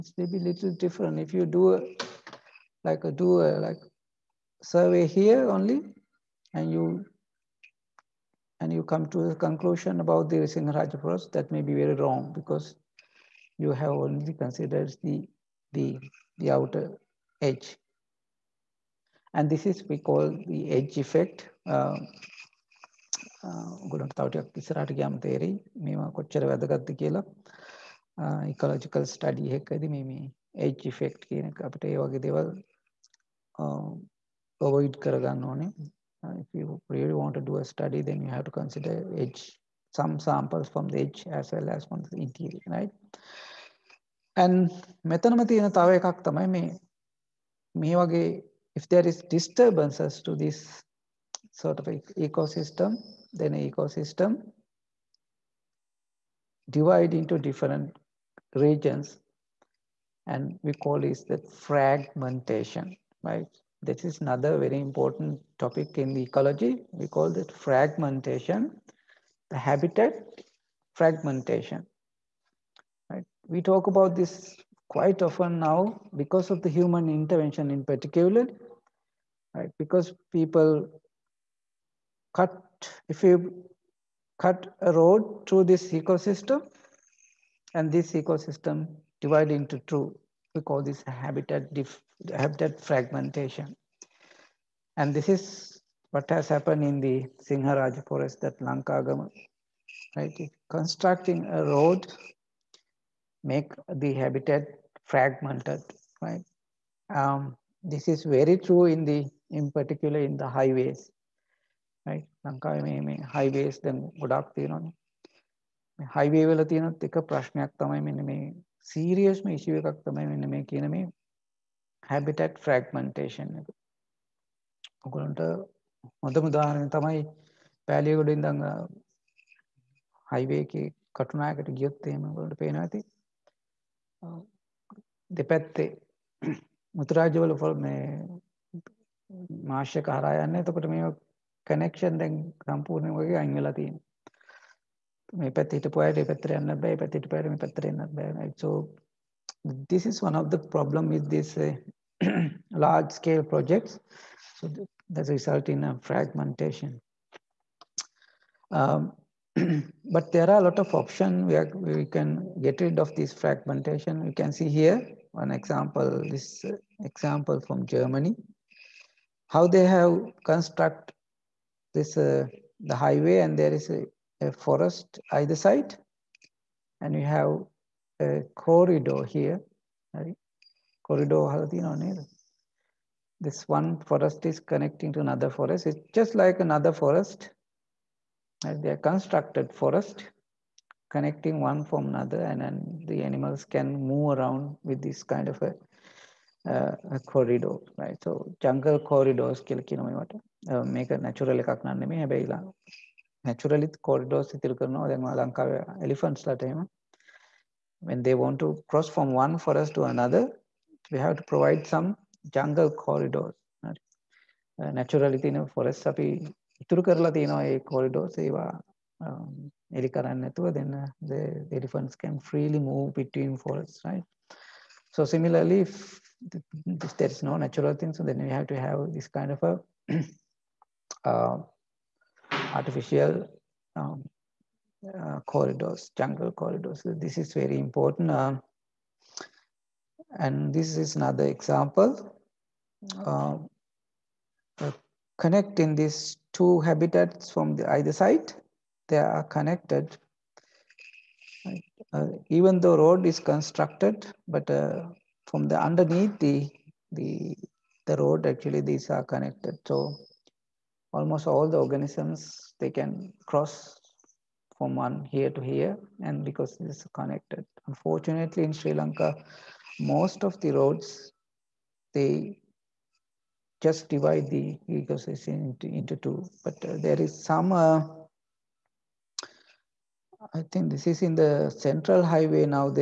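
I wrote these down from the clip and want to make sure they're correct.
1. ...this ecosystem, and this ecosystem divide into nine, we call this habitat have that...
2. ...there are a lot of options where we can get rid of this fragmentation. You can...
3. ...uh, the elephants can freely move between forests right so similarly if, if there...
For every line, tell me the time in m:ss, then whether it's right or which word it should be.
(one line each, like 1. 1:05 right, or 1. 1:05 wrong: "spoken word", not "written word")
1. 1:25 wrong: "two", not "nine"
2. 2:40 right
3. 3:40 right.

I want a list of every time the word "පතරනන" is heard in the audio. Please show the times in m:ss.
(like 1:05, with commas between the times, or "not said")
2:27.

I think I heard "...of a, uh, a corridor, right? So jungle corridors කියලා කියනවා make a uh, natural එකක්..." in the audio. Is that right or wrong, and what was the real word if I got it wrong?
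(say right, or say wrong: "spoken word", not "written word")
right.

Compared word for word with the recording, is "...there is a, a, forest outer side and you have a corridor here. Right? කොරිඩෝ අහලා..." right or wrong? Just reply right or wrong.
wrong.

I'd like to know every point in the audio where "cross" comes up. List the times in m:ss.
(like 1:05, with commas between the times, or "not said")
3:28, 4:23.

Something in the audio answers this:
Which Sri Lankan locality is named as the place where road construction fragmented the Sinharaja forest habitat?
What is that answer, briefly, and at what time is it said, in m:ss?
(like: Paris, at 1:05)
Lankagama, at 1:38.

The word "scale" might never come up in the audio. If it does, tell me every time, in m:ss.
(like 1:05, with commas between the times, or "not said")
2:33.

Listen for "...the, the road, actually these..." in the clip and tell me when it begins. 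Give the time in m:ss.
4:17.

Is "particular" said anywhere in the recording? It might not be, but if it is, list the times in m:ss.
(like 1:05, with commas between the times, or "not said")
1:17, 1:49.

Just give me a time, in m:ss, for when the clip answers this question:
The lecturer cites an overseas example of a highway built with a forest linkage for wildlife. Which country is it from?
2:47.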